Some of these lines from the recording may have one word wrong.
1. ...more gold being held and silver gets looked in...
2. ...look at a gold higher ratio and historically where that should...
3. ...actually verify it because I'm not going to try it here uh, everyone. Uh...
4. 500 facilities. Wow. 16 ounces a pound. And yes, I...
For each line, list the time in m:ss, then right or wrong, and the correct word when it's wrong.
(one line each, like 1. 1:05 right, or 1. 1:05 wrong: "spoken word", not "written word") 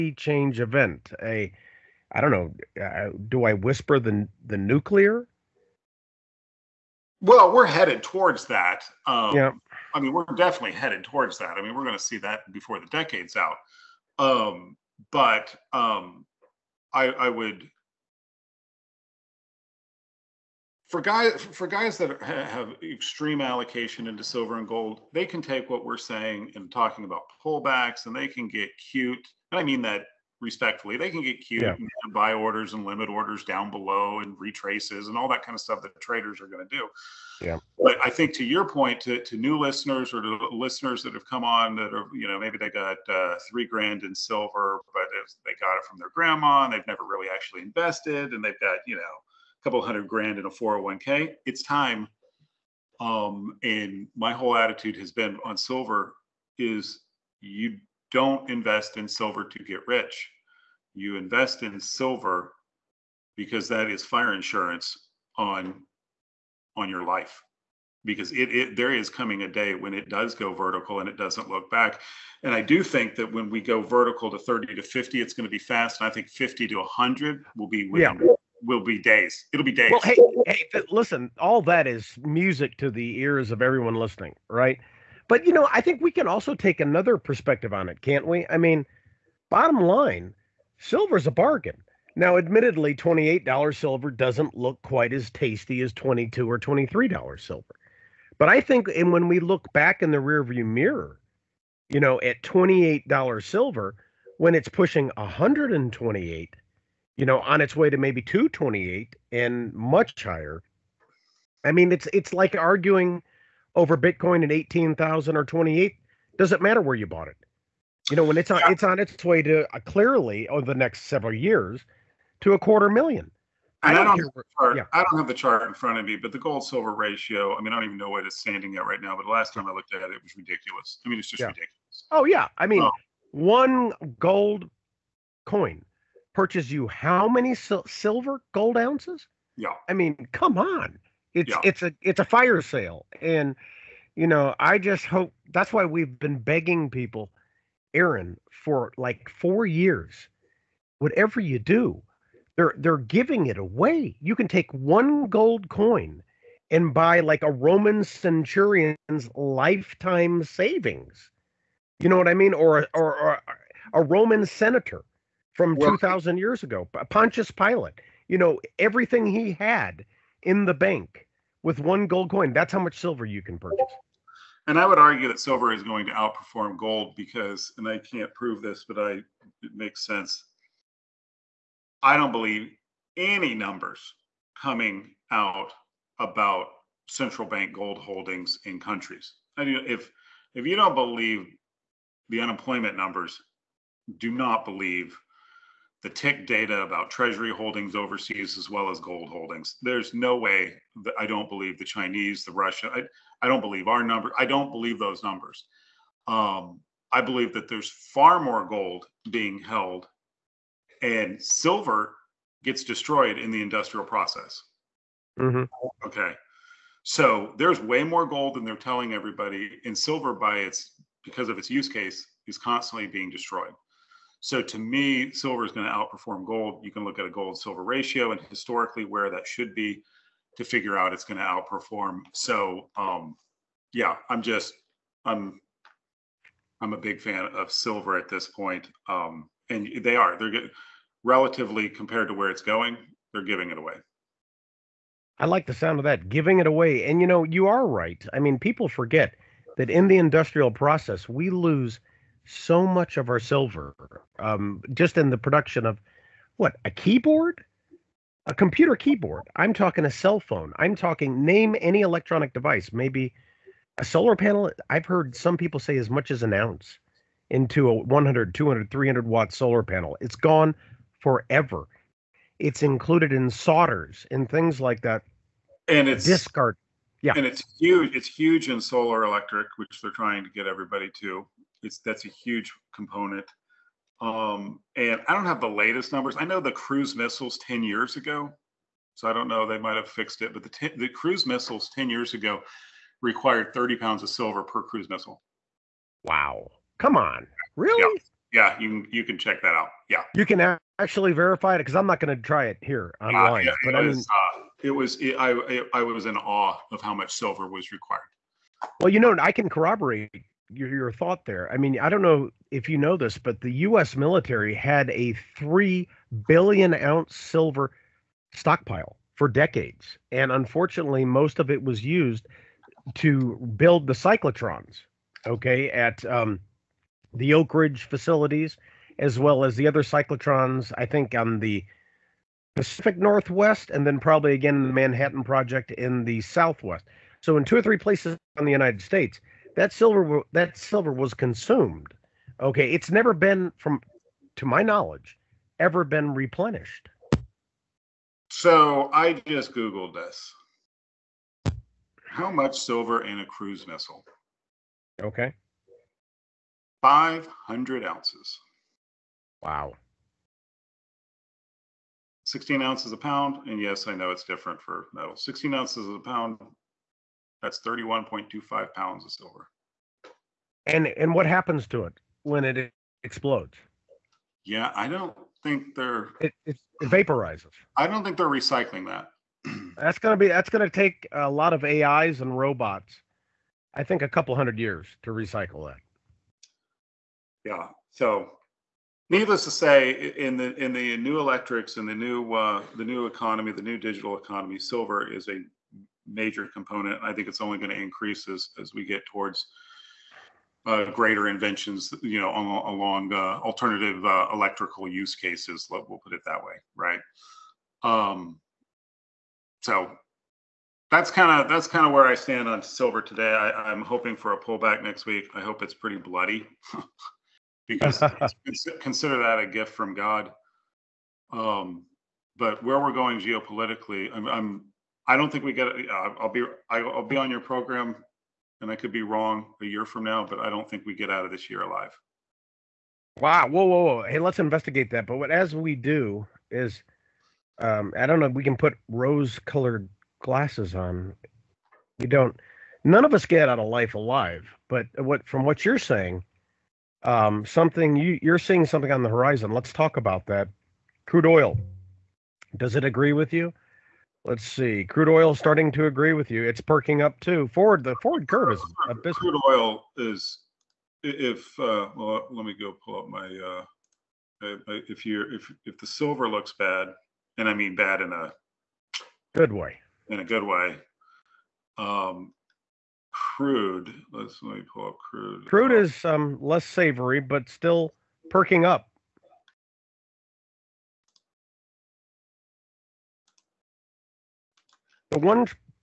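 1. 3:28 wrong: "destroyed", not "looked"
2. 3:47 wrong: "silver", not "higher"
3. 5:00 wrong: "online", not "everyone"
4. 5:57 wrong: "ounces", not "facilities".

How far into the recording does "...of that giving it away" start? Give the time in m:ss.
4:05.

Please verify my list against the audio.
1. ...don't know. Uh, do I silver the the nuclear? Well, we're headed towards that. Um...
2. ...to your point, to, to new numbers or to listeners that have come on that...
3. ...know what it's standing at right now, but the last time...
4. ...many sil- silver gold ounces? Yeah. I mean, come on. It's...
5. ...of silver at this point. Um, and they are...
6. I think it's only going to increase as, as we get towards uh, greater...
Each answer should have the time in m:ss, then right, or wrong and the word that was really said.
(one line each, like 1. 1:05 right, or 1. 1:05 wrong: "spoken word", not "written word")
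1. 0:02 wrong: "whisper", not "silver"
2. 0:38 wrong: "listeners", not "numbers"
3. 2:07 right
4. 2:17 right
5. 3:57 right
6. 6:37 right.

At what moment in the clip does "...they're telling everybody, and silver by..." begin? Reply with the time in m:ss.
3:38.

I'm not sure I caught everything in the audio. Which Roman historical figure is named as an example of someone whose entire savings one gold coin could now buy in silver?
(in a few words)
Pontius Pilate.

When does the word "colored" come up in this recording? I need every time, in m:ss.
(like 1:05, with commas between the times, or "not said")
7:19.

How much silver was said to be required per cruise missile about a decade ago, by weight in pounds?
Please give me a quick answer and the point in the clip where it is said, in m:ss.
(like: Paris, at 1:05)
30 pounds, at 4:53.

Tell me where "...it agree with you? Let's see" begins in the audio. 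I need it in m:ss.
7:32.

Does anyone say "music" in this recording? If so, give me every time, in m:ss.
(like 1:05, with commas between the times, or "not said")
1:22.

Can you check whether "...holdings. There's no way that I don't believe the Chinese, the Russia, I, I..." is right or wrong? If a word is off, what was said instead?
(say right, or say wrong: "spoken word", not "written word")
right.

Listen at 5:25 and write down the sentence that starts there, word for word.
Okay, at um, the Oak Ridge facilities, as well as the other cyclotrons.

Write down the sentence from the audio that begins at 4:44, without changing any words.
Um, and I don't have the latest numbers.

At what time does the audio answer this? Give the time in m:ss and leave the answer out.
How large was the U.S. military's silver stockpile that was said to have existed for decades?
5:15.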